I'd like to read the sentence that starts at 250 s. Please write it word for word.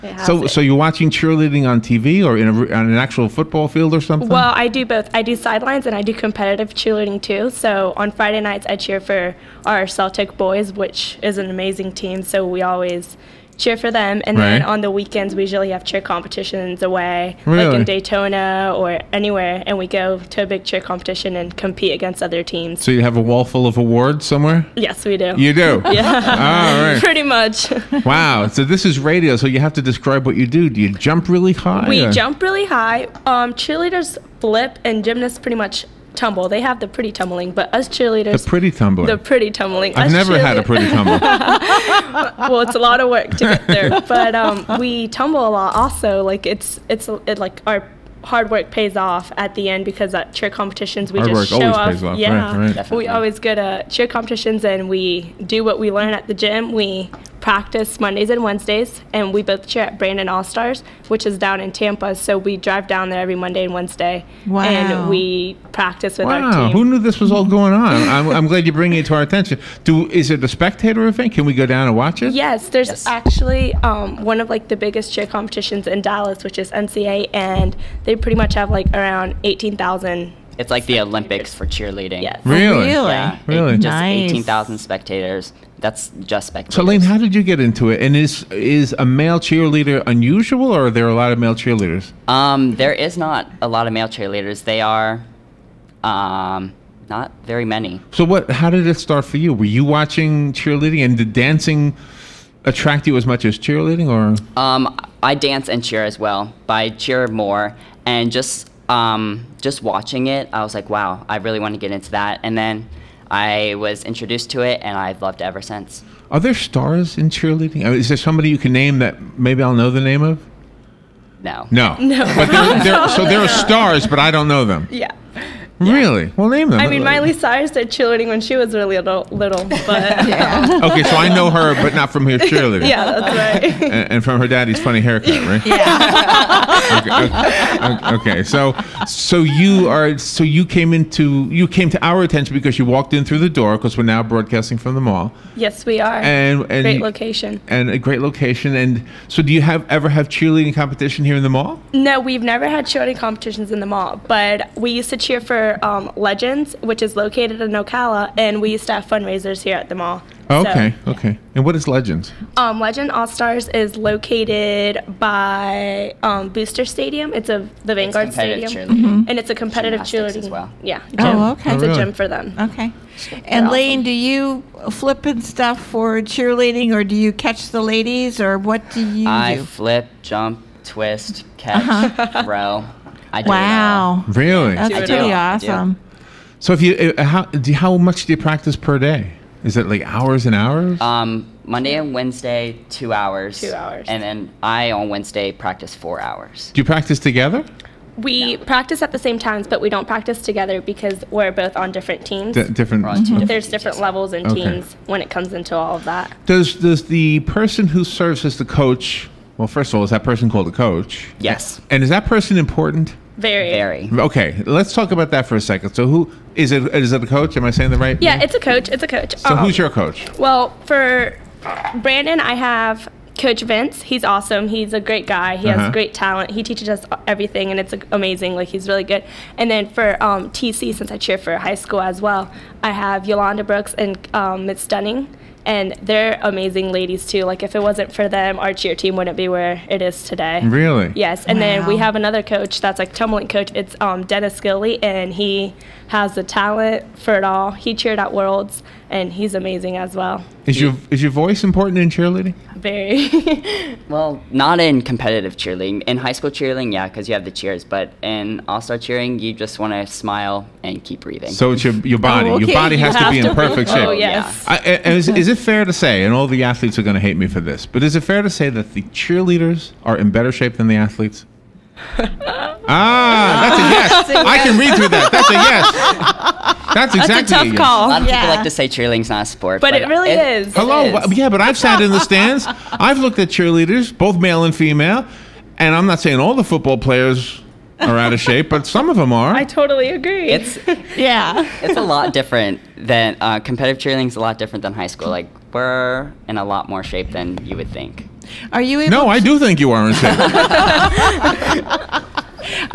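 Is your is your voice important in cheerleading?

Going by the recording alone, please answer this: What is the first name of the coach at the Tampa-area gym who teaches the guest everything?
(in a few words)
Vince.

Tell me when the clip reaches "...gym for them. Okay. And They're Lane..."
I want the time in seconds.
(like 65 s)
172 s.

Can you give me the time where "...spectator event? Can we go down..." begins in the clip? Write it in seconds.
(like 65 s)
70 s.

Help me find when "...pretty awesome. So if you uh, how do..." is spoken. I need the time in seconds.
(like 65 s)
185 s.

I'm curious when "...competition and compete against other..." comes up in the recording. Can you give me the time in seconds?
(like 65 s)
20 s.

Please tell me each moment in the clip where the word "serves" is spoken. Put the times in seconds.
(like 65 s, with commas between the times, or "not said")
208 s.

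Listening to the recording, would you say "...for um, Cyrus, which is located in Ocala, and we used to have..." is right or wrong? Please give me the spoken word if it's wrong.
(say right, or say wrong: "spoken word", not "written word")
wrong: "Legends", not "Cyrus".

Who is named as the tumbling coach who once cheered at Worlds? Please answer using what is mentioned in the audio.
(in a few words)
Dennis Gilly.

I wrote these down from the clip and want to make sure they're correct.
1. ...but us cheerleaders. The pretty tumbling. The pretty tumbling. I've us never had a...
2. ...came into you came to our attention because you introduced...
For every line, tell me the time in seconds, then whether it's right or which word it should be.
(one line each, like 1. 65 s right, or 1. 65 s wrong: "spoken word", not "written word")
1. 37 s right
2. 140 s wrong: "walked", not "introduced".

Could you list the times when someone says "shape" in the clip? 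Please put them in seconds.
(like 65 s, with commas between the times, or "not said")
263 s, 270 s, 288 s, 297 s.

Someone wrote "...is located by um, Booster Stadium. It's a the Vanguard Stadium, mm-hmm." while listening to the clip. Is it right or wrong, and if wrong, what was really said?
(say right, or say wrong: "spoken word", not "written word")
right.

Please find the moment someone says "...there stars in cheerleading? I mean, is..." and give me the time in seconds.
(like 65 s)
116 s.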